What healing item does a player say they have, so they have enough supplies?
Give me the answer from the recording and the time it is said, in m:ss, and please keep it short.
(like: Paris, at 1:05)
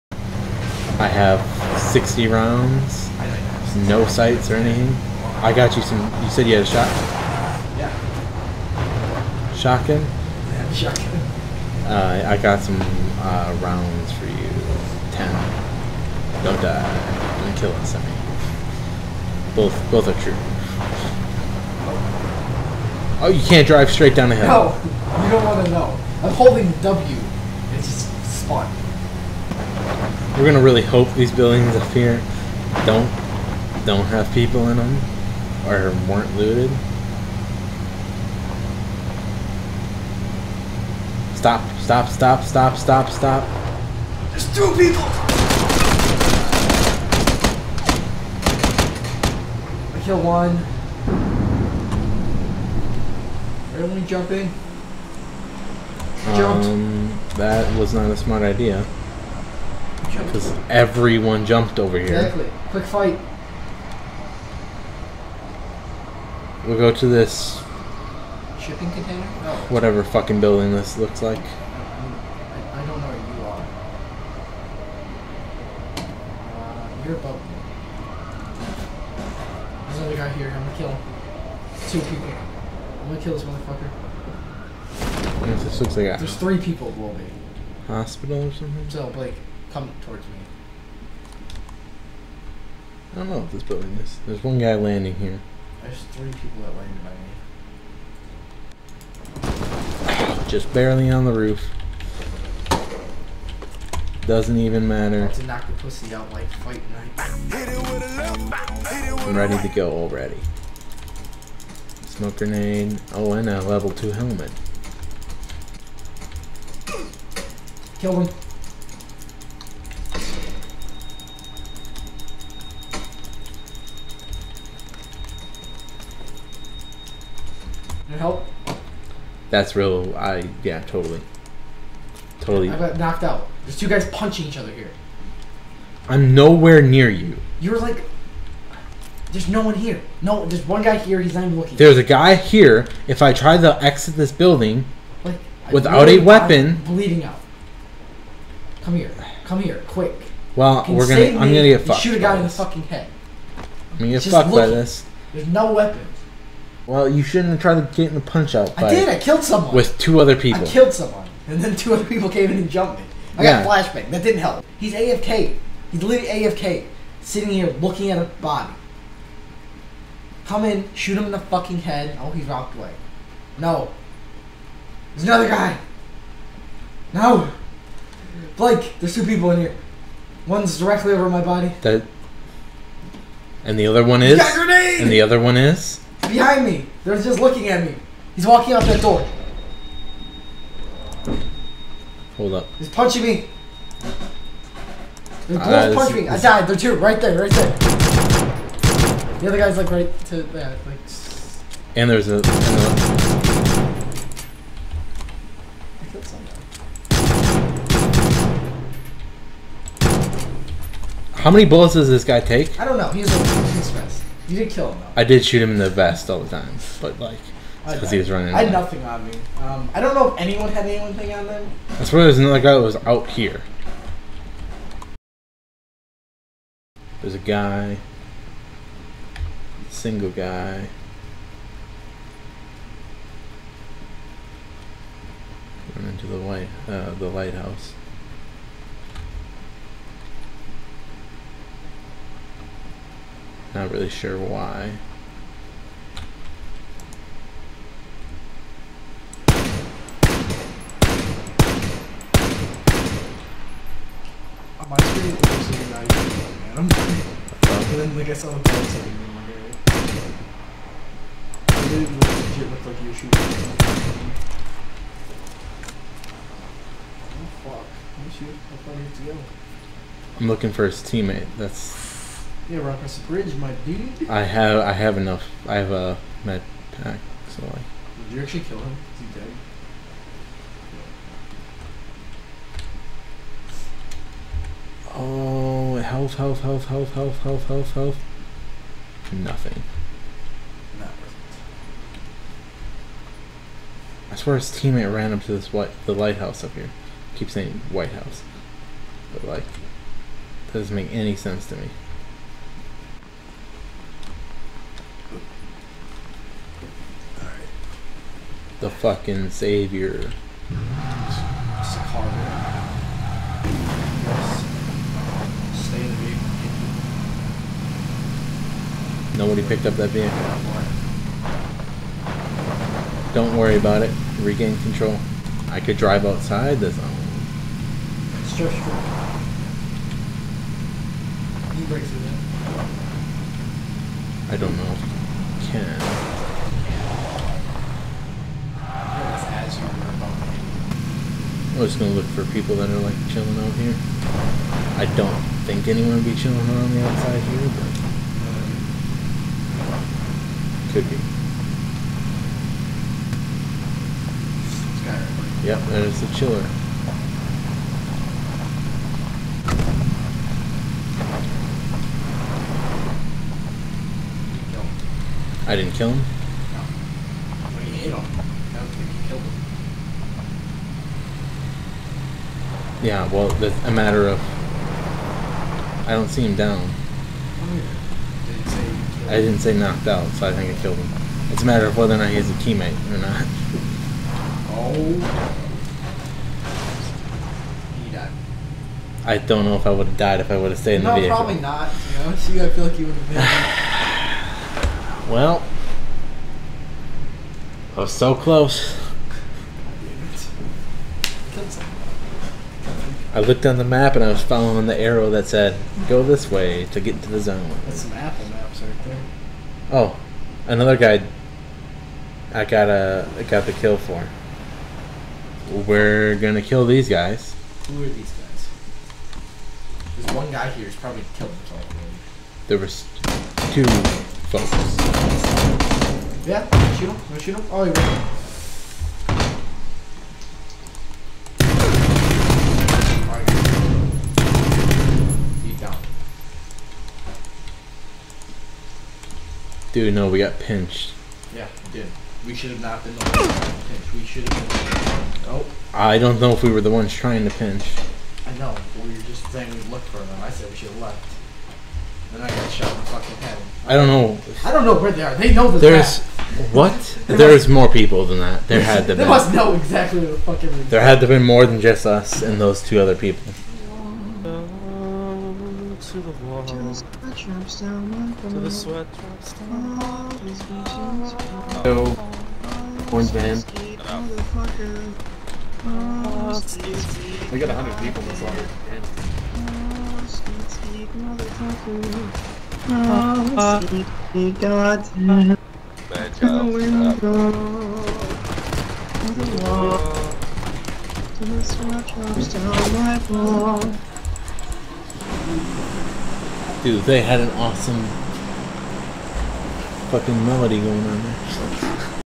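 Med pack, at 4:36.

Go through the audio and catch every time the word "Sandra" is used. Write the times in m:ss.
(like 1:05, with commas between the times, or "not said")
not said.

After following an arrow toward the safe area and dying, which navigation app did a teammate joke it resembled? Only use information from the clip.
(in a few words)
Apple Maps.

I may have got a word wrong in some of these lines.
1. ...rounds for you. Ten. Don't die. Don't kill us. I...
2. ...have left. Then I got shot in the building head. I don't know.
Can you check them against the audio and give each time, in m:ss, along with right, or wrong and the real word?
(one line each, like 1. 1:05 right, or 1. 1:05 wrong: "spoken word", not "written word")
1. 0:13 right
2. 7:30 wrong: "fucking", not "building".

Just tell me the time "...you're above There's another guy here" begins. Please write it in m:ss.
1:17.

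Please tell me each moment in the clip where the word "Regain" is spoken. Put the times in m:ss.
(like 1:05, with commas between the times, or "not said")
5:24.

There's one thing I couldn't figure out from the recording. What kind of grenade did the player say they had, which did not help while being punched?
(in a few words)
Flashbang.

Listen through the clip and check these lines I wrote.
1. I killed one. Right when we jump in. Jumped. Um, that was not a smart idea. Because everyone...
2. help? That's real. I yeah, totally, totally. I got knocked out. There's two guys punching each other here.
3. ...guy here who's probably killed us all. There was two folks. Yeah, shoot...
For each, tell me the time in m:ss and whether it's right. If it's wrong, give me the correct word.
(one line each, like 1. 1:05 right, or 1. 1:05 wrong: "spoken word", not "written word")
1. 0:49 right
2. 2:08 right
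3. 7:00 right.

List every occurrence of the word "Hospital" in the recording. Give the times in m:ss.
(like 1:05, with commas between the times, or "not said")
1:27.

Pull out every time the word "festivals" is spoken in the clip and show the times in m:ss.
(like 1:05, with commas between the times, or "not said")
not said.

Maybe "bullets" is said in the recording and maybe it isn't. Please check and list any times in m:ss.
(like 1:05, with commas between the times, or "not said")
3:31.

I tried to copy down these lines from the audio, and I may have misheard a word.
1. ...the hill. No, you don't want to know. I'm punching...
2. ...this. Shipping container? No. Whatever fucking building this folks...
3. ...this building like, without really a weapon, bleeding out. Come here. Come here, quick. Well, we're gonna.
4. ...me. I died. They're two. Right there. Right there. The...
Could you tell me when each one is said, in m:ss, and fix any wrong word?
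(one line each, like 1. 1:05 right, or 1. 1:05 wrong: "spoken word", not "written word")
1. 0:24 wrong: "holding", not "punching"
2. 1:07 wrong: "looks", not "folks"
3. 2:24 right
4. 3:16 right.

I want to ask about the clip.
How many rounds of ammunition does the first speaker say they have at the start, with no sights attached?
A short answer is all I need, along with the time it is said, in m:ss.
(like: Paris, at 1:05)
60, at 0:01.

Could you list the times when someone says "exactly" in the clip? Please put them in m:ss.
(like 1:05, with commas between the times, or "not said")
1:02, 7:39.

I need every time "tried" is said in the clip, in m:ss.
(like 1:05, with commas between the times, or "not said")
2:37.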